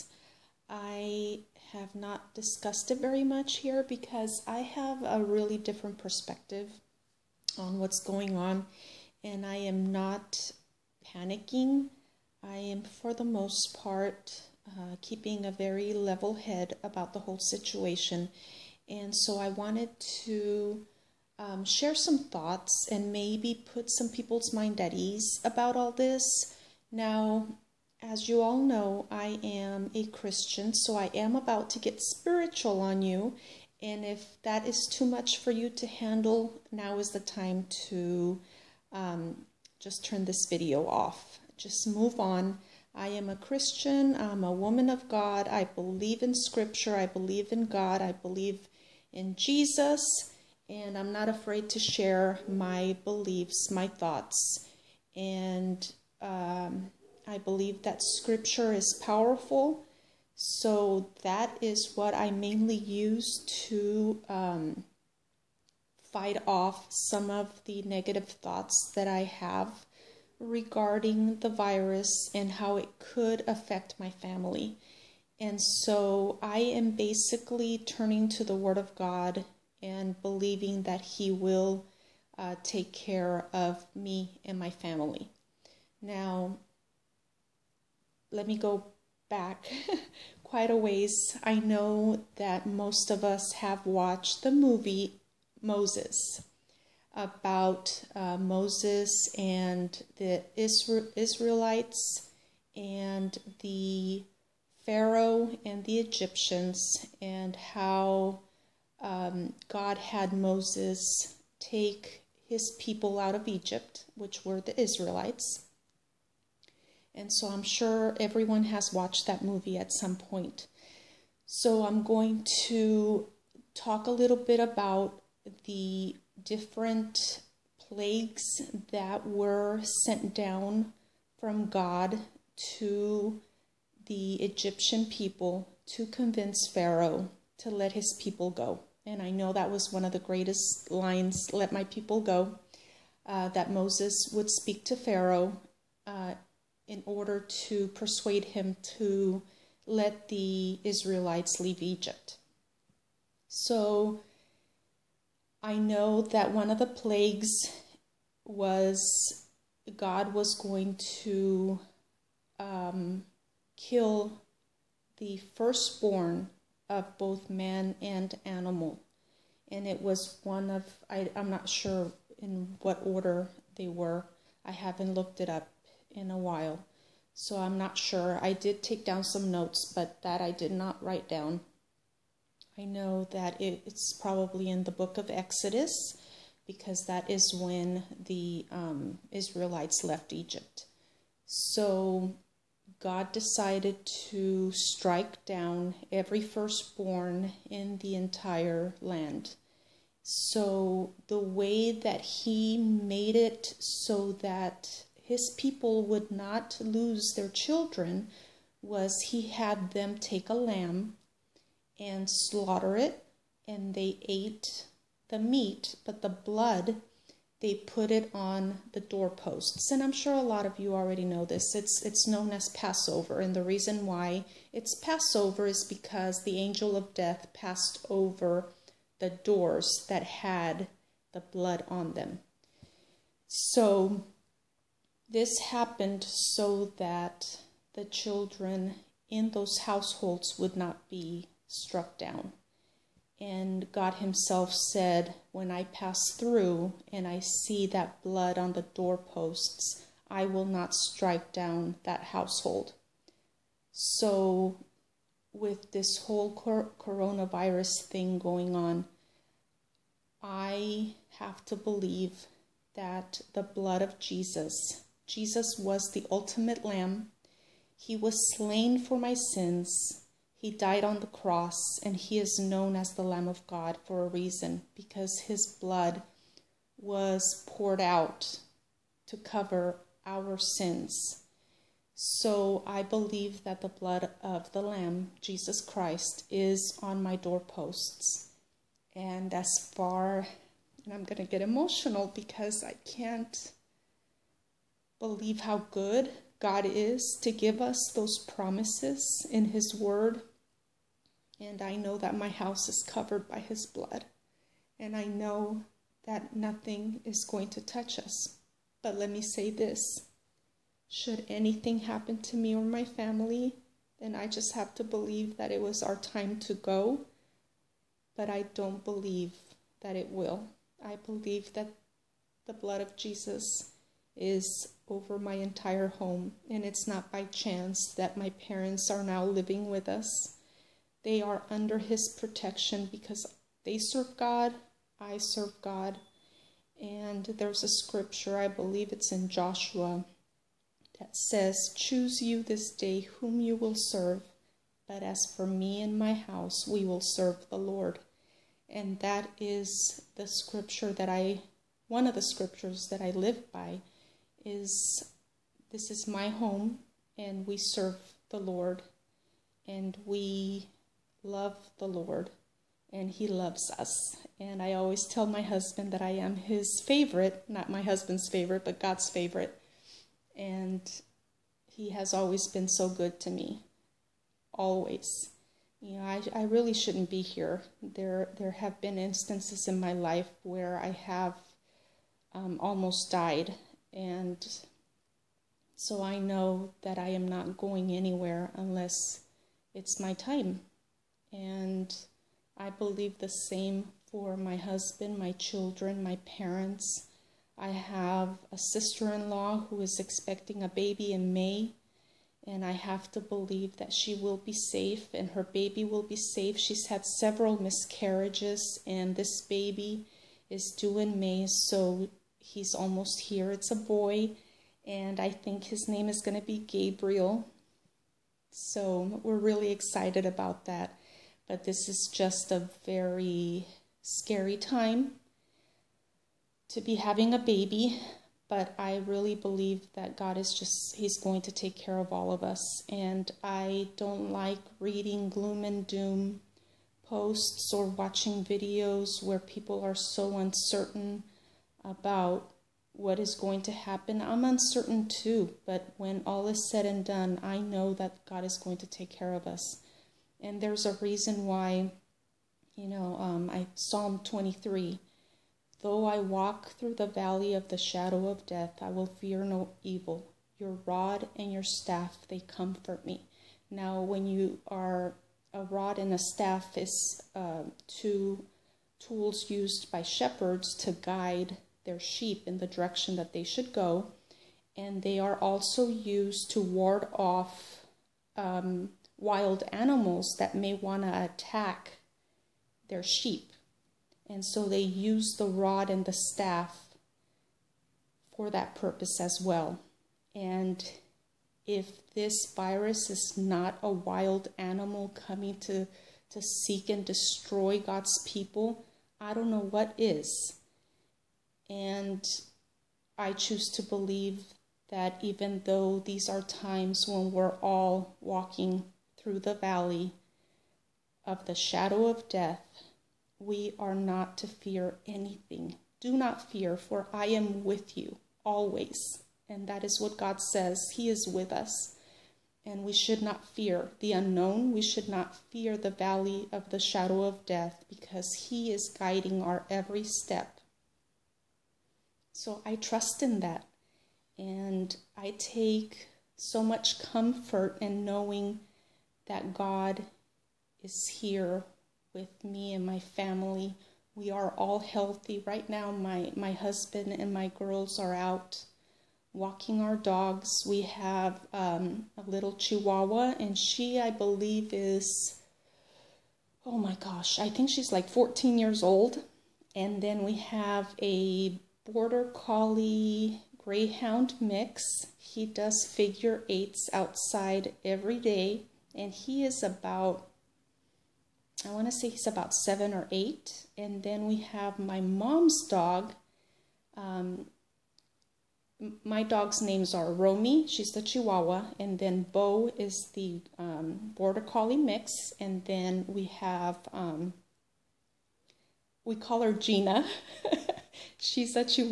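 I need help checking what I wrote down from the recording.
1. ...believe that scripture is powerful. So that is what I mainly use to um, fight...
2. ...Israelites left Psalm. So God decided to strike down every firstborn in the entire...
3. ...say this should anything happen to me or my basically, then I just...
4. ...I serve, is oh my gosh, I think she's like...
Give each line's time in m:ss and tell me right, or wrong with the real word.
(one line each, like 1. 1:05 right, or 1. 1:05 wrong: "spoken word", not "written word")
1. 0:57 right
2. 3:09 wrong: "Egypt", not "Psalm"
3. 5:09 wrong: "family", not "basically"
4. 9:14 wrong: "believe", not "serve".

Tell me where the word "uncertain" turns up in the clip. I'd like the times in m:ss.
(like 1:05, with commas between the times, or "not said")
7:20, 7:24.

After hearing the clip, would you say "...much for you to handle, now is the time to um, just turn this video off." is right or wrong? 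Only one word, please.
right.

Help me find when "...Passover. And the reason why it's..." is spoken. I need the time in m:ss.
3:42.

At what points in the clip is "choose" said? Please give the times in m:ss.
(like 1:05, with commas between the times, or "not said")
5:41, 8:23.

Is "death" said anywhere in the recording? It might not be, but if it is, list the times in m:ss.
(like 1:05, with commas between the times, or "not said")
3:47, 7:38, 8:32, 8:47.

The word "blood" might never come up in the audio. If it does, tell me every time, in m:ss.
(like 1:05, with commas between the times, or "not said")
3:36, 3:51, 4:08, 4:23, 4:35, 4:43, 5:03, 5:22.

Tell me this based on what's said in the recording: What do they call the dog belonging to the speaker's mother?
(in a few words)
Gina.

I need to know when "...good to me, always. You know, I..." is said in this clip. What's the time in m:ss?
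6:13.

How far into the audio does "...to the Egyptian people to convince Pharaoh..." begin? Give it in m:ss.
2:12.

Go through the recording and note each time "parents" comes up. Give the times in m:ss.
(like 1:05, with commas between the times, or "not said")
5:28, 6:36.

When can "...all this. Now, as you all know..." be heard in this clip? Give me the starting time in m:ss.
0:25.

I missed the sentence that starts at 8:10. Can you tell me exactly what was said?
And if this virus is not a wild animal coming to, to seek and destroy God's people, I don't know what is.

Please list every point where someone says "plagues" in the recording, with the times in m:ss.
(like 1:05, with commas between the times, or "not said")
2:07, 2:36.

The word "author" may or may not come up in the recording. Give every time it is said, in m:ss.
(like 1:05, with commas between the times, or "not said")
not said.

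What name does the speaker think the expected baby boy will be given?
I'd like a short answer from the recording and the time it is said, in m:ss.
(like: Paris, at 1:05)
Gabriel, at 6:56.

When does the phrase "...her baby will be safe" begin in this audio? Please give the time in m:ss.
6:45.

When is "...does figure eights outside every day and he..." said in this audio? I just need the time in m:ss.
9:25.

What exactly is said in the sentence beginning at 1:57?
And so I'm sure everyone has watched that movie at some point.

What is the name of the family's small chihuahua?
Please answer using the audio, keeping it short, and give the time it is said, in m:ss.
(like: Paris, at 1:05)
Romy, at 9:40.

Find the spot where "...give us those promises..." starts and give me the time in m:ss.
4:57.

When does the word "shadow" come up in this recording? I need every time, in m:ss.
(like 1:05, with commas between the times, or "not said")
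7:37, 8:31, 8:46.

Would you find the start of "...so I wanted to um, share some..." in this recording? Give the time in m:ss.
0:19.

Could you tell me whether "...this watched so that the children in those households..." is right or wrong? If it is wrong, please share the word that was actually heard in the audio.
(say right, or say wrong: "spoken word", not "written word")
wrong: "happened", not "watched".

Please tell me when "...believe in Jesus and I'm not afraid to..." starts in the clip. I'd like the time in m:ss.
0:48.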